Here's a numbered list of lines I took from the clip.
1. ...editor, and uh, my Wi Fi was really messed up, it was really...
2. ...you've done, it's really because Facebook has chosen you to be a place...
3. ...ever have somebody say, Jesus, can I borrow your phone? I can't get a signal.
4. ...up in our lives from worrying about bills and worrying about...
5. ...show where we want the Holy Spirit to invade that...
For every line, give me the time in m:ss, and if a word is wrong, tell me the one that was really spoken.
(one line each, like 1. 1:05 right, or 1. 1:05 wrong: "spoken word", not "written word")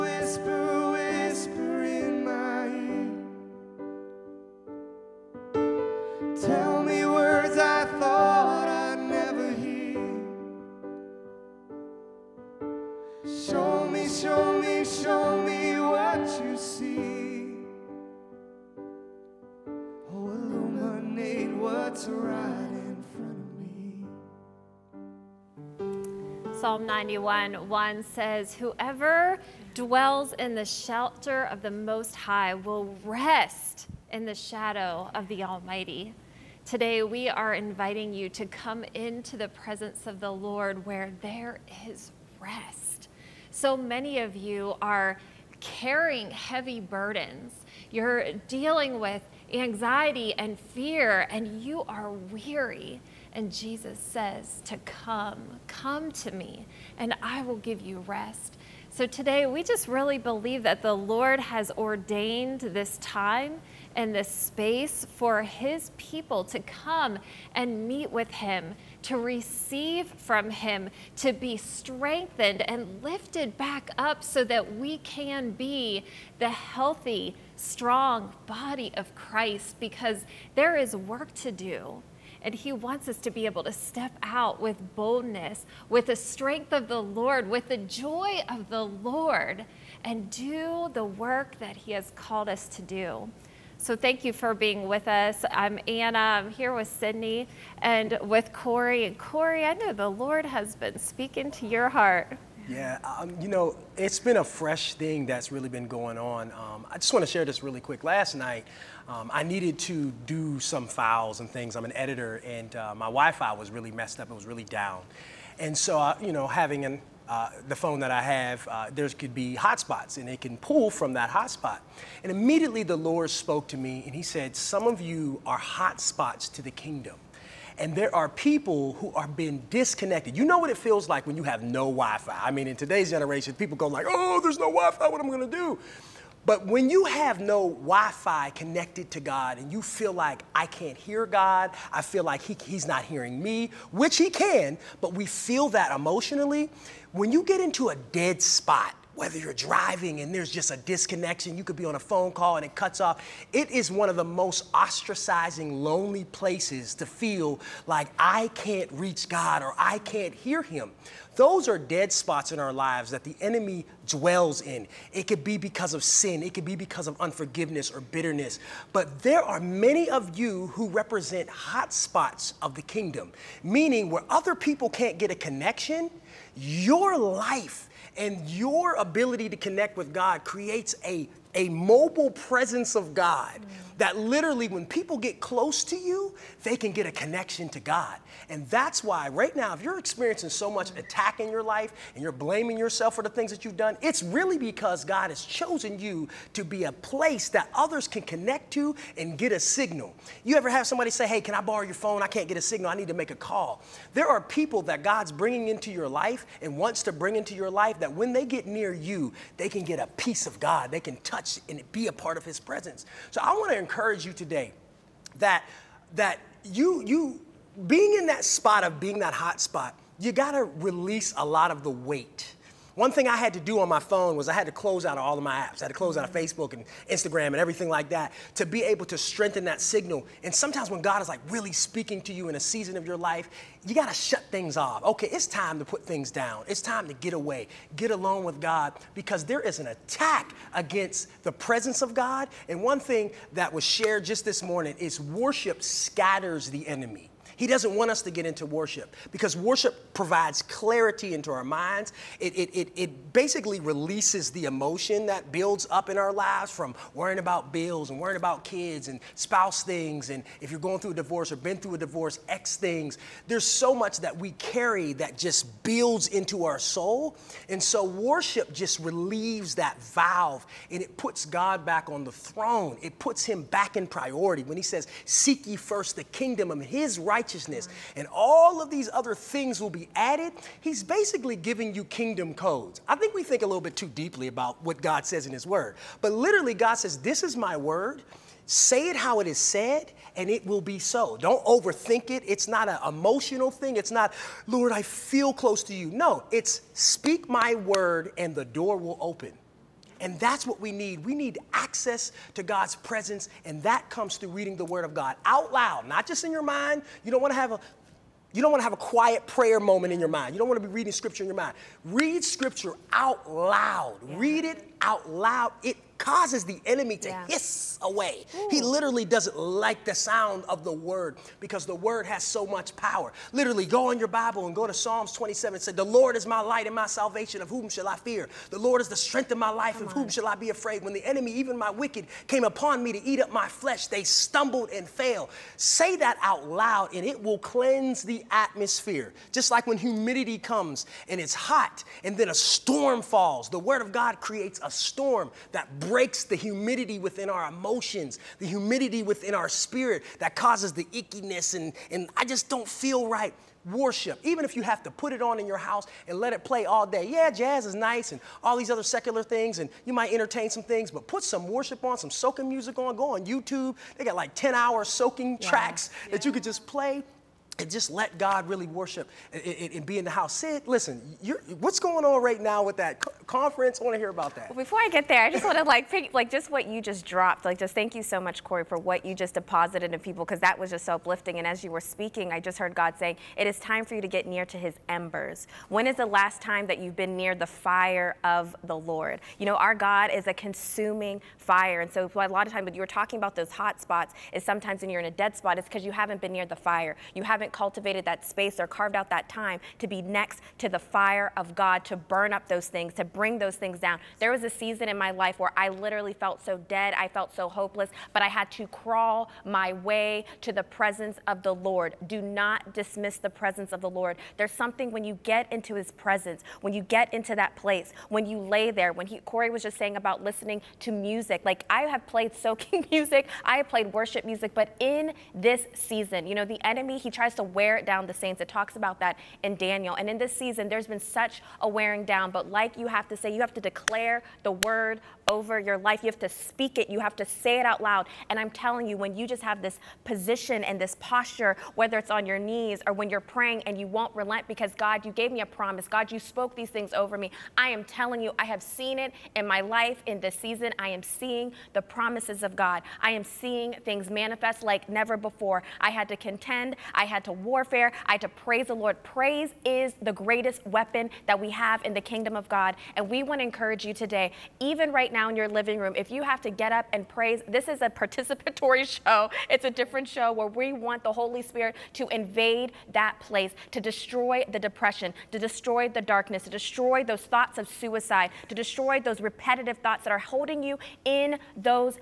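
1. 1:51 right
2. 3:13 wrong: "God", not "Facebook"
3. 3:20 wrong: "Hey", not "Jesus"
4. 4:15 right
5. 7:50 right.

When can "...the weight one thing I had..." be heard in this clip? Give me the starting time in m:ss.
3:41.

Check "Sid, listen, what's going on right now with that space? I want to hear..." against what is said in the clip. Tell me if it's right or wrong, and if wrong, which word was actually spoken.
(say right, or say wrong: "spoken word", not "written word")
wrong: "conference", not "space".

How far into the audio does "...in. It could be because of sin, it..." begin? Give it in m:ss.
2:44.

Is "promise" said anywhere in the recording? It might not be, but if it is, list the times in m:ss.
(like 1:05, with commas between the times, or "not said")
7:25, 7:32.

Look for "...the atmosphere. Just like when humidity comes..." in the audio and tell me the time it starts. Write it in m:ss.
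5:38.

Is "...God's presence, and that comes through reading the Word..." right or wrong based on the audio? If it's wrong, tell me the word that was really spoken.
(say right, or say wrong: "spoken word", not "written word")
right.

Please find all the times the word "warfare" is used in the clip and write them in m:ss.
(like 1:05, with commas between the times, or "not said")
7:37.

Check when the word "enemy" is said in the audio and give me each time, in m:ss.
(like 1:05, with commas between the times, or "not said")
2:43, 4:06, 5:16, 5:31, 7:06.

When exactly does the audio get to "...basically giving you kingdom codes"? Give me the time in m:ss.
4:41.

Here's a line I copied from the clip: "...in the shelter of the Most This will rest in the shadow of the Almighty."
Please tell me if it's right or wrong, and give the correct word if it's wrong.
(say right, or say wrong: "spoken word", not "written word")
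wrong: "High", not "This".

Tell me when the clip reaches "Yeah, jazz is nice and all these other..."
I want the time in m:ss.
5:57.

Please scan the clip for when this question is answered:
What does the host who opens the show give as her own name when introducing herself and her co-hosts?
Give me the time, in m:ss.
1:35.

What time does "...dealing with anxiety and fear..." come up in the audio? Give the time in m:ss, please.
0:48.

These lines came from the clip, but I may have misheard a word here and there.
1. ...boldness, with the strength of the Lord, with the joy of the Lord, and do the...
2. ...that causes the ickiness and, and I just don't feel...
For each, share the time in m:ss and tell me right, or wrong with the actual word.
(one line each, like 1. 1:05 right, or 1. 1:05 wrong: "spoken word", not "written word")
1. 1:24 right
2. 5:50 right.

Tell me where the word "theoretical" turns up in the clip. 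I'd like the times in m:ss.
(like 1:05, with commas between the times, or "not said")
not said.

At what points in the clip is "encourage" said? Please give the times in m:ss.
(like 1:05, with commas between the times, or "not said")
3:33, 7:43.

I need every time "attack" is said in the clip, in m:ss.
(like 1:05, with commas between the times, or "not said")
3:10, 3:59.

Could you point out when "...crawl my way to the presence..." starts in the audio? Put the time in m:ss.
6:48.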